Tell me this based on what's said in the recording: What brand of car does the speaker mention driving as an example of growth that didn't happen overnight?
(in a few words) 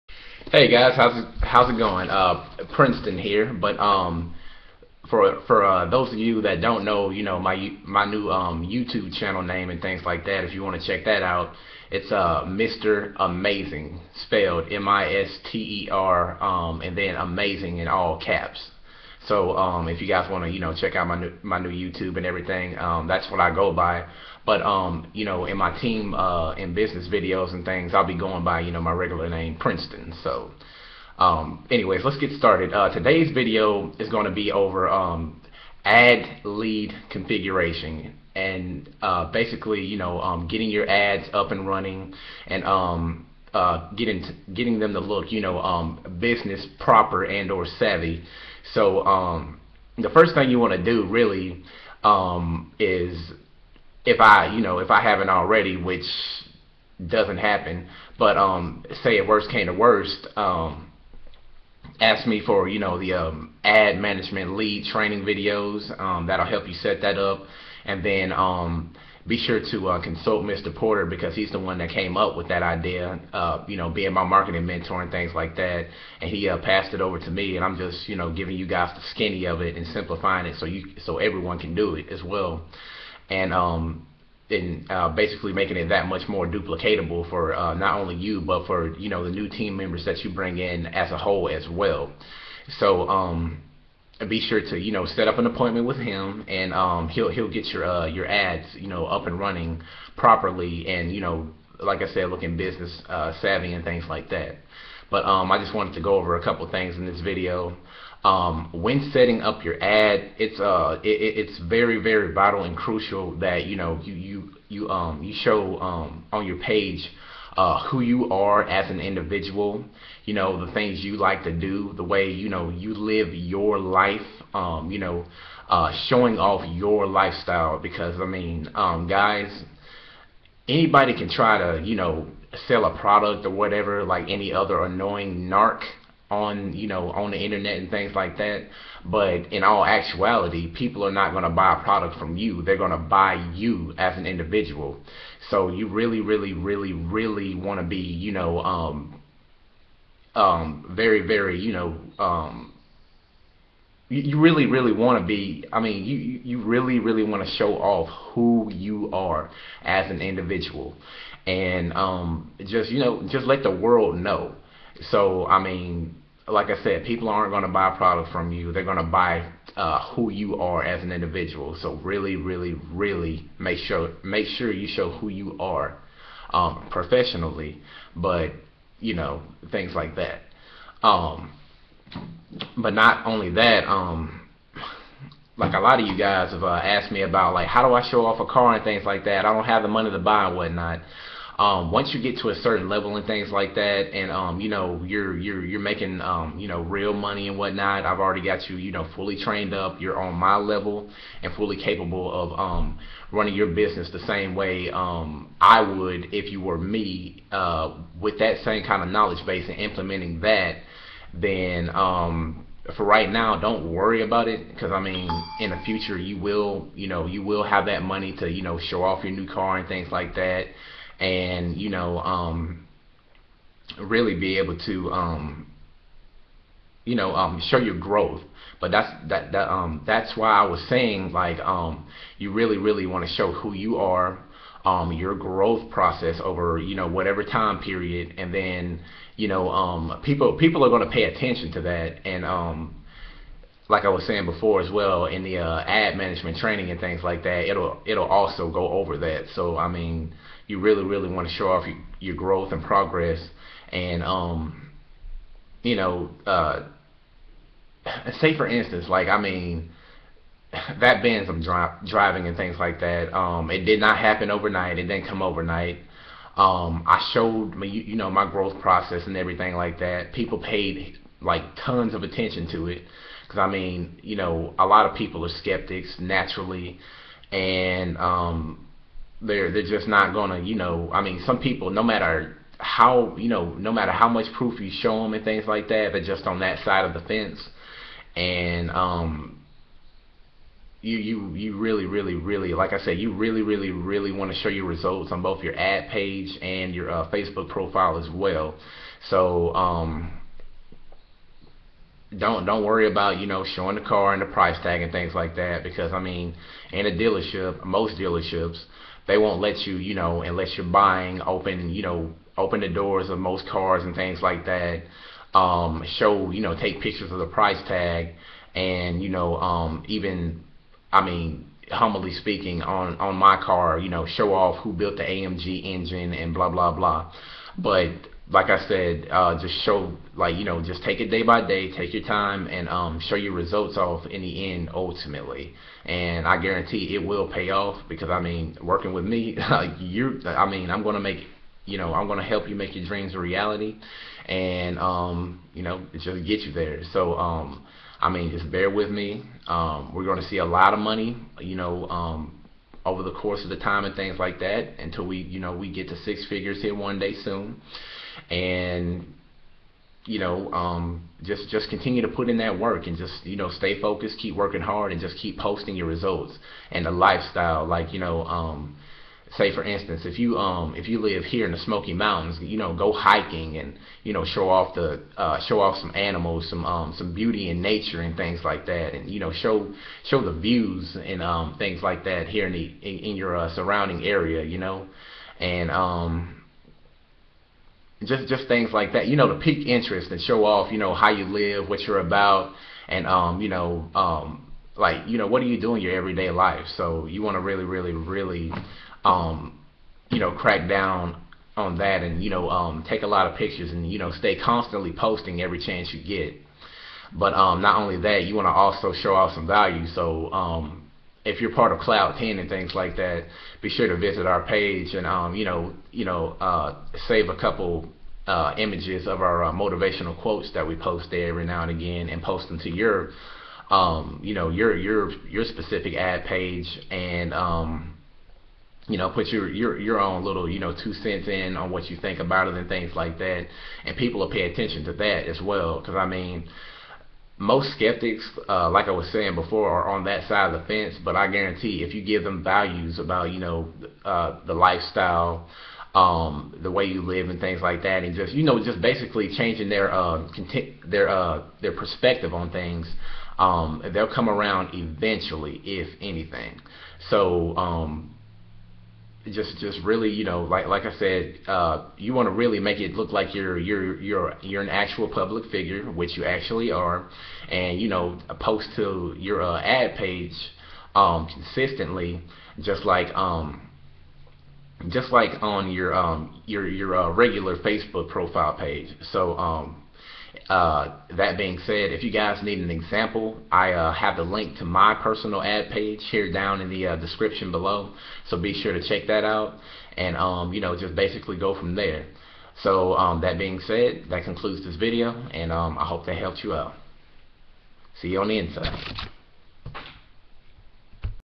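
Benz.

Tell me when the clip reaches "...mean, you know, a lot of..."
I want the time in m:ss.
4:33.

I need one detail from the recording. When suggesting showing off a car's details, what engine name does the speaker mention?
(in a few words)
AMG.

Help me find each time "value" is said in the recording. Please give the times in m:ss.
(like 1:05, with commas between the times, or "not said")
6:49, 7:22.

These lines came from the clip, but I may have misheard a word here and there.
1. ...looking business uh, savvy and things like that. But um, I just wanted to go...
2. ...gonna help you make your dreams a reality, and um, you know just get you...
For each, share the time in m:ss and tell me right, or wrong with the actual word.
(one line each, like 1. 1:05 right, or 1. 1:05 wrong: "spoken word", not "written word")
1. 1:42 right
2. 5:42 right.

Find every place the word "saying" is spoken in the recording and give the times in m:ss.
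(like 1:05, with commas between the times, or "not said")
3:50, 4:04, 7:19.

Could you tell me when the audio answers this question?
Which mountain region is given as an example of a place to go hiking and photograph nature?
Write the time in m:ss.
6:11.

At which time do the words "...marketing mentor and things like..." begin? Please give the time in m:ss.
1:14.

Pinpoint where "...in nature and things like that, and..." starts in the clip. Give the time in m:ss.
6:17.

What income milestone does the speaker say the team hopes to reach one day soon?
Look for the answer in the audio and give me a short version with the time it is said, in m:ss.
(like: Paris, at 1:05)
six figures, at 5:56.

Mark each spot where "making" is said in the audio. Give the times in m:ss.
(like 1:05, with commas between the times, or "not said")
1:25, 3:15.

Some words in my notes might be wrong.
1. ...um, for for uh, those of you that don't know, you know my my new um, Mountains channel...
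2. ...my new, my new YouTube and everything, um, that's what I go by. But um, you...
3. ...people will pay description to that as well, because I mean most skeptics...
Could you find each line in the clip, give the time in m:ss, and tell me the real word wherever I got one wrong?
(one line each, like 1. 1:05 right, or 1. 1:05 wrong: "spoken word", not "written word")
1. 0:03 wrong: "YouTube", not "Mountains"
2. 0:21 right
3. 7:14 wrong: "attention", not "description".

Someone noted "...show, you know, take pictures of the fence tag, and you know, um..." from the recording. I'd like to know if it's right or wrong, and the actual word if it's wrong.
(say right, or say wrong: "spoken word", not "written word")
wrong: "price", not "fence".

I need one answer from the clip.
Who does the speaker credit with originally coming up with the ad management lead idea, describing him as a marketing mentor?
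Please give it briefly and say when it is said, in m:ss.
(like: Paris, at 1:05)
Mr. Porter, at 1:10.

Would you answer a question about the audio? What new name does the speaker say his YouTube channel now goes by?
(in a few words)
Mr. Amazing.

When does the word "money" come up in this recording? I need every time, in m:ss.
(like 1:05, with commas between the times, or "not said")
3:09, 3:17, 3:38, 5:50.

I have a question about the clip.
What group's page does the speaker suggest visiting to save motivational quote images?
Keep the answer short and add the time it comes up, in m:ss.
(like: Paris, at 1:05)
Cloud 10, at 6:51.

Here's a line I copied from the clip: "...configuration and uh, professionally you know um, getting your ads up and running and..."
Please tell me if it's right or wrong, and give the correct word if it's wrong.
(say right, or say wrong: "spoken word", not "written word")
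wrong: "basically", not "professionally".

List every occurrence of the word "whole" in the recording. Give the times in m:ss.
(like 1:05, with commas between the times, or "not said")
1:31.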